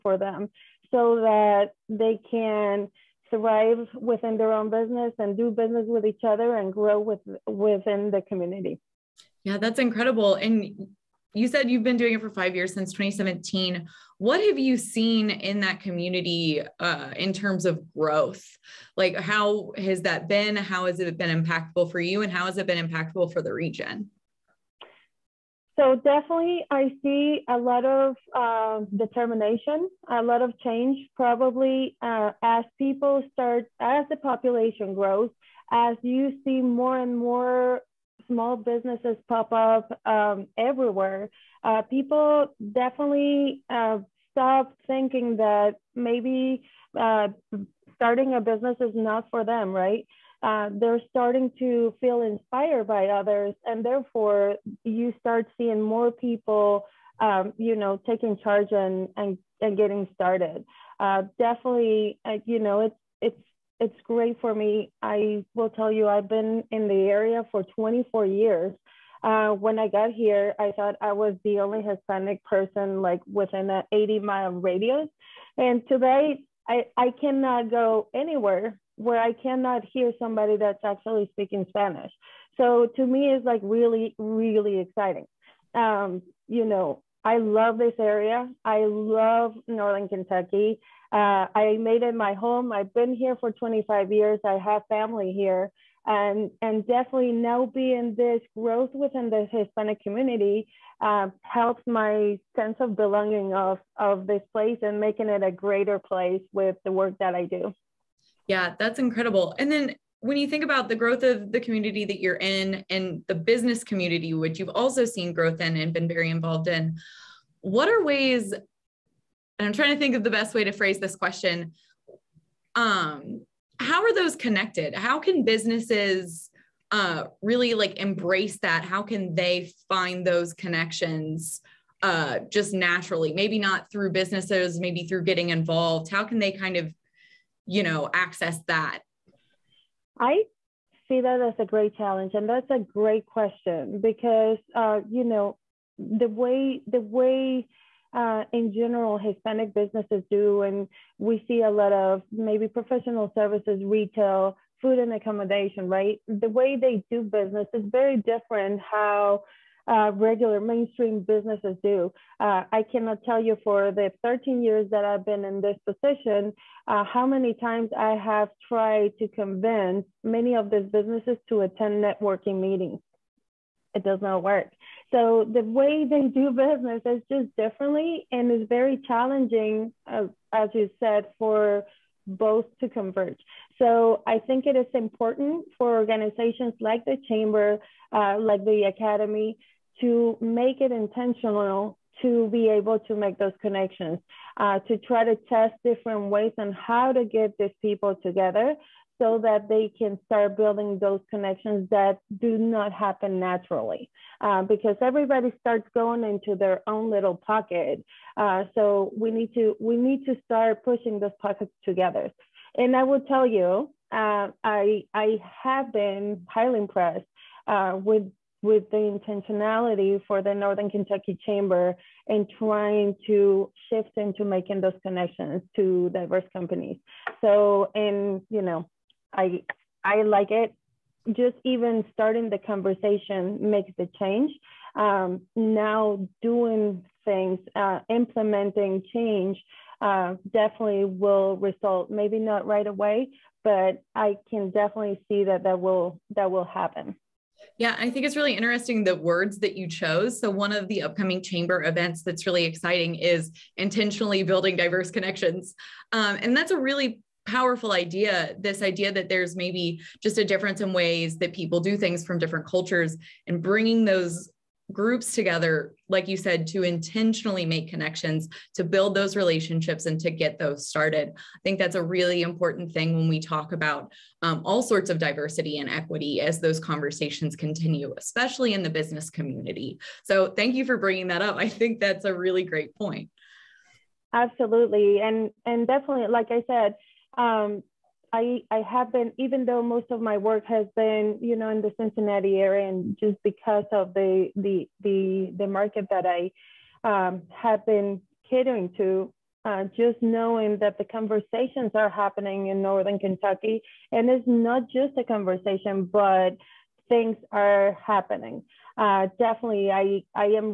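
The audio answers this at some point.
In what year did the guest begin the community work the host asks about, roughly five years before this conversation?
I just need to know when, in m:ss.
0:12.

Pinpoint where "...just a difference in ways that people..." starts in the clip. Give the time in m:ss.
4:20.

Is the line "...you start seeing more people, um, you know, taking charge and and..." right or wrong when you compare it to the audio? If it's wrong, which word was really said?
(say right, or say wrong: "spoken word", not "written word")
right.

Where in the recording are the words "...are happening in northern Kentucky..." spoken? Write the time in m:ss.
5:01.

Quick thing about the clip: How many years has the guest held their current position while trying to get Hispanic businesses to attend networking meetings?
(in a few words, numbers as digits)
13.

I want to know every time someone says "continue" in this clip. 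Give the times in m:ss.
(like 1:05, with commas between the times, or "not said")
4:37.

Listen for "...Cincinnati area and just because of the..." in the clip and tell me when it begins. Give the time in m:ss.
4:51.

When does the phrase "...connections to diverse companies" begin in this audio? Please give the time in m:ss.
3:45.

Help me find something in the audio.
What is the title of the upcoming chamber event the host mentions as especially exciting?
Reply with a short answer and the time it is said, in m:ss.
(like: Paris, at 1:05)
Intentionally building diverse connections, at 4:13.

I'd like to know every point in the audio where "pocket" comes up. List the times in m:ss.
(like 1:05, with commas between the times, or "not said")
3:27, 3:31.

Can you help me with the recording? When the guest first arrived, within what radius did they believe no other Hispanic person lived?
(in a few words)
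80 miles.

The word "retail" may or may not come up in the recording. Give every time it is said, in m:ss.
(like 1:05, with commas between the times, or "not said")
2:33.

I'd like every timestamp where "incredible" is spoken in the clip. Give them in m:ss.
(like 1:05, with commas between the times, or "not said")
0:09, 1:48.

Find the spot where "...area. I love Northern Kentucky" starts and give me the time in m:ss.
1:27.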